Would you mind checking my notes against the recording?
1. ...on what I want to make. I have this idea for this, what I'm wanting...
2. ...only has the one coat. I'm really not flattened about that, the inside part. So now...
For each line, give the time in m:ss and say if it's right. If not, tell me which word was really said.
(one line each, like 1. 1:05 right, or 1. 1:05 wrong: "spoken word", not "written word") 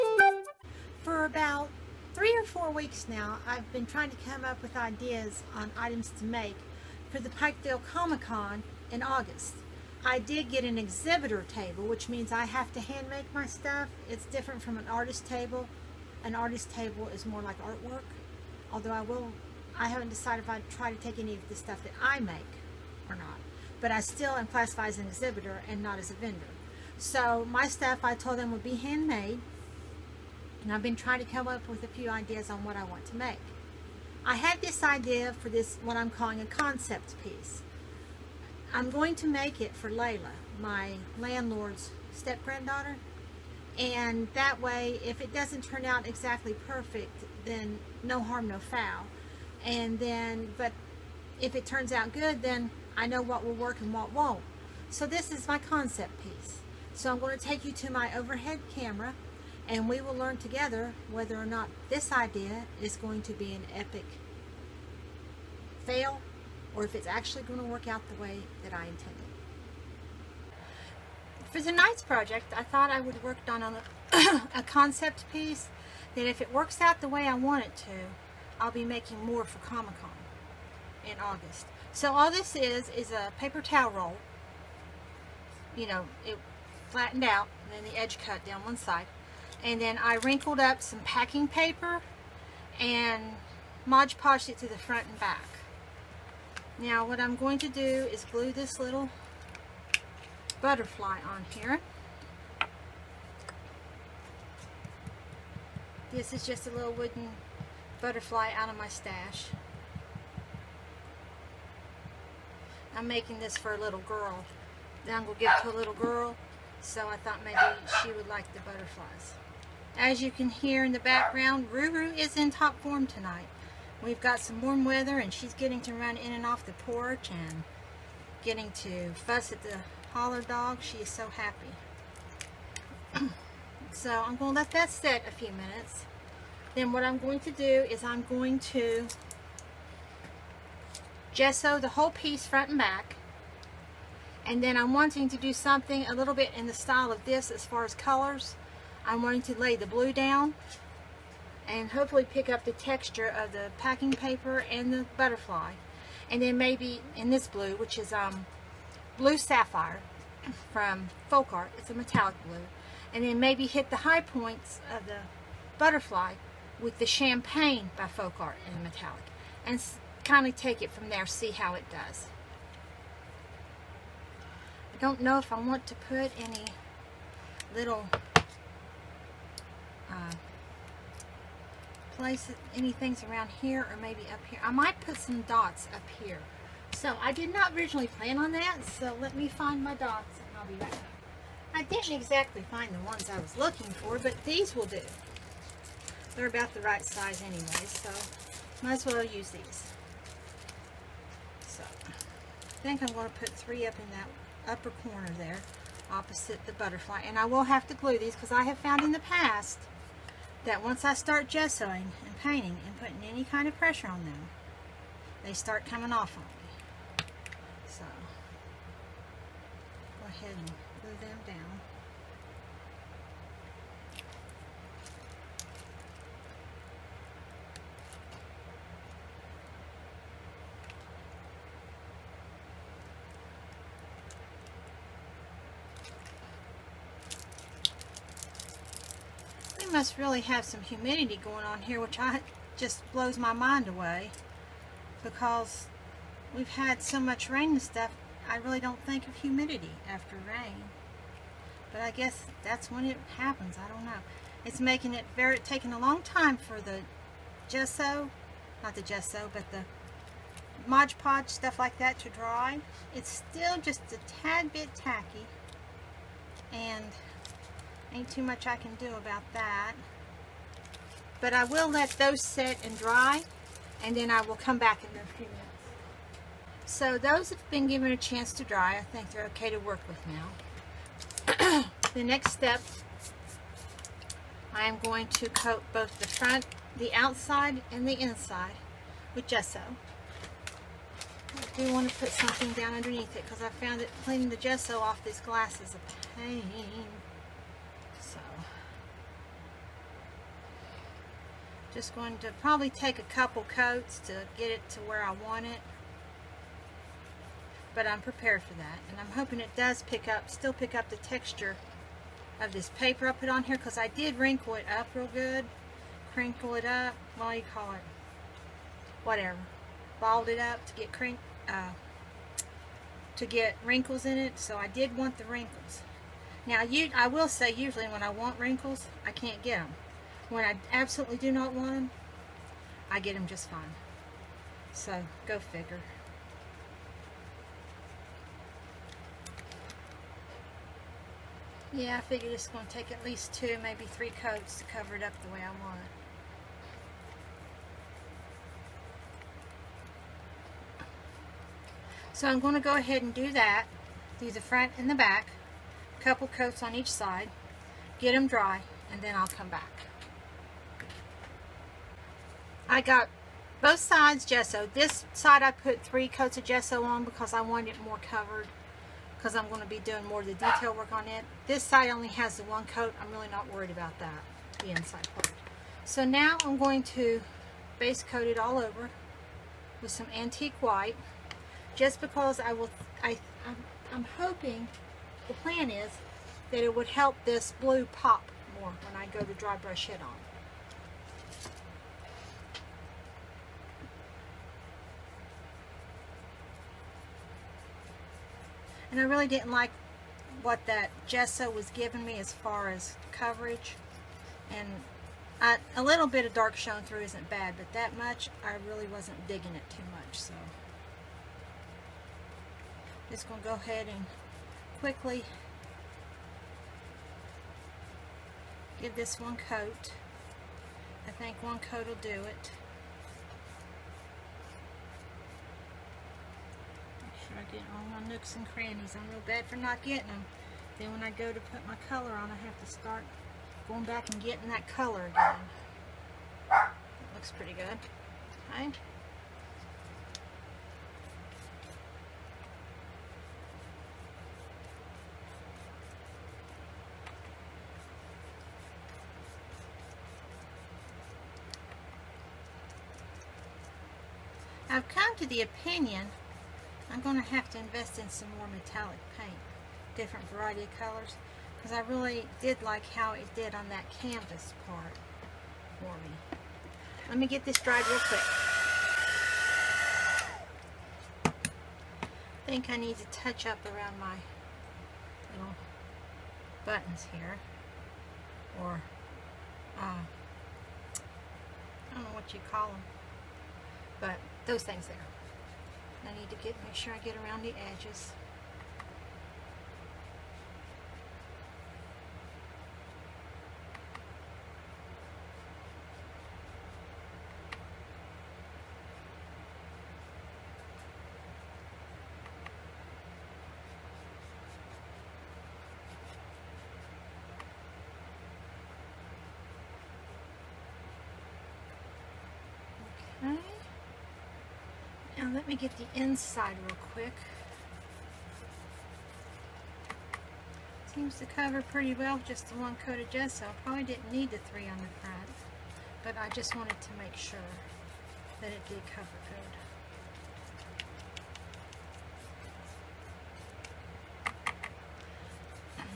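1. 0:32 wrong: "calling", not "wanting"
2. 6:12 wrong: "worried", not "flattened".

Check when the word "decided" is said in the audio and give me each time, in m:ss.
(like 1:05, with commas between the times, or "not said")
0:20.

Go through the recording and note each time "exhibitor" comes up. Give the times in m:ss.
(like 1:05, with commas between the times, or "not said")
0:10, 0:25.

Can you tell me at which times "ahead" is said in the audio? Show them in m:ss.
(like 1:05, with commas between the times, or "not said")
3:40, 5:52, 6:53.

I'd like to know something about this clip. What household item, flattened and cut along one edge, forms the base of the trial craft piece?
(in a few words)
paper towel roll.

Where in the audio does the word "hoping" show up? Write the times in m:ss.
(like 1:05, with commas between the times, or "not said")
5:09, 6:24.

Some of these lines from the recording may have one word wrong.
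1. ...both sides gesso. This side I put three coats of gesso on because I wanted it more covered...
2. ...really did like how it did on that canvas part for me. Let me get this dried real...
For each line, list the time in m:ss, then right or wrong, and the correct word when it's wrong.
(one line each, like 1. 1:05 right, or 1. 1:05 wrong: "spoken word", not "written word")
1. 6:03 right
2. 7:42 right.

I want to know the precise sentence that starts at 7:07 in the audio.
I get all my nooks and crannies.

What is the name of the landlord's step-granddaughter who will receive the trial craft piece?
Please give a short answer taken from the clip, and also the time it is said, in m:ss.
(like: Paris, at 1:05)
Layla, at 0:39.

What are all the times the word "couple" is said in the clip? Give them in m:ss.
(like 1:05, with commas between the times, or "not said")
5:03, 5:56.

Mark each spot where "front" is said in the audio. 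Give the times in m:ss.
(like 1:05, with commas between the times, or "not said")
1:34, 2:22, 4:46, 5:54, 8:45.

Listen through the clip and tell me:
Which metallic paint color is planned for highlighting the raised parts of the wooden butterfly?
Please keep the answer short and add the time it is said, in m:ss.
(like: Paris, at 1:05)
Champagne, at 2:47.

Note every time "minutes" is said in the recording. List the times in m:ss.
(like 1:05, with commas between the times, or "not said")
2:15, 4:35.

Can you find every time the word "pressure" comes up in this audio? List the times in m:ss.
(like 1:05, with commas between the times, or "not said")
3:33.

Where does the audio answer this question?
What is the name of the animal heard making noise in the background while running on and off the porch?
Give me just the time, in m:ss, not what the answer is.
2:01.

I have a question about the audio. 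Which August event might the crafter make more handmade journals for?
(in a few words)
Pikeville Comic Con.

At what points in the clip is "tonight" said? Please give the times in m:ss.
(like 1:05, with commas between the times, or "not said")
1:11, 2:03.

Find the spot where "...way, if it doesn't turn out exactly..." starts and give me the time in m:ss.
0:44.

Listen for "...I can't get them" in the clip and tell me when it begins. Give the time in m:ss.
5:29.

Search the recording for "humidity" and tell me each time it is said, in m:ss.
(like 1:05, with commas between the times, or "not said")
4:00, 4:09.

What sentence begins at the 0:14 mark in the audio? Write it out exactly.
It's different from an artist table.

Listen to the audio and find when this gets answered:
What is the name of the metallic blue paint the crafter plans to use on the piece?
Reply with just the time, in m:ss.
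2:39.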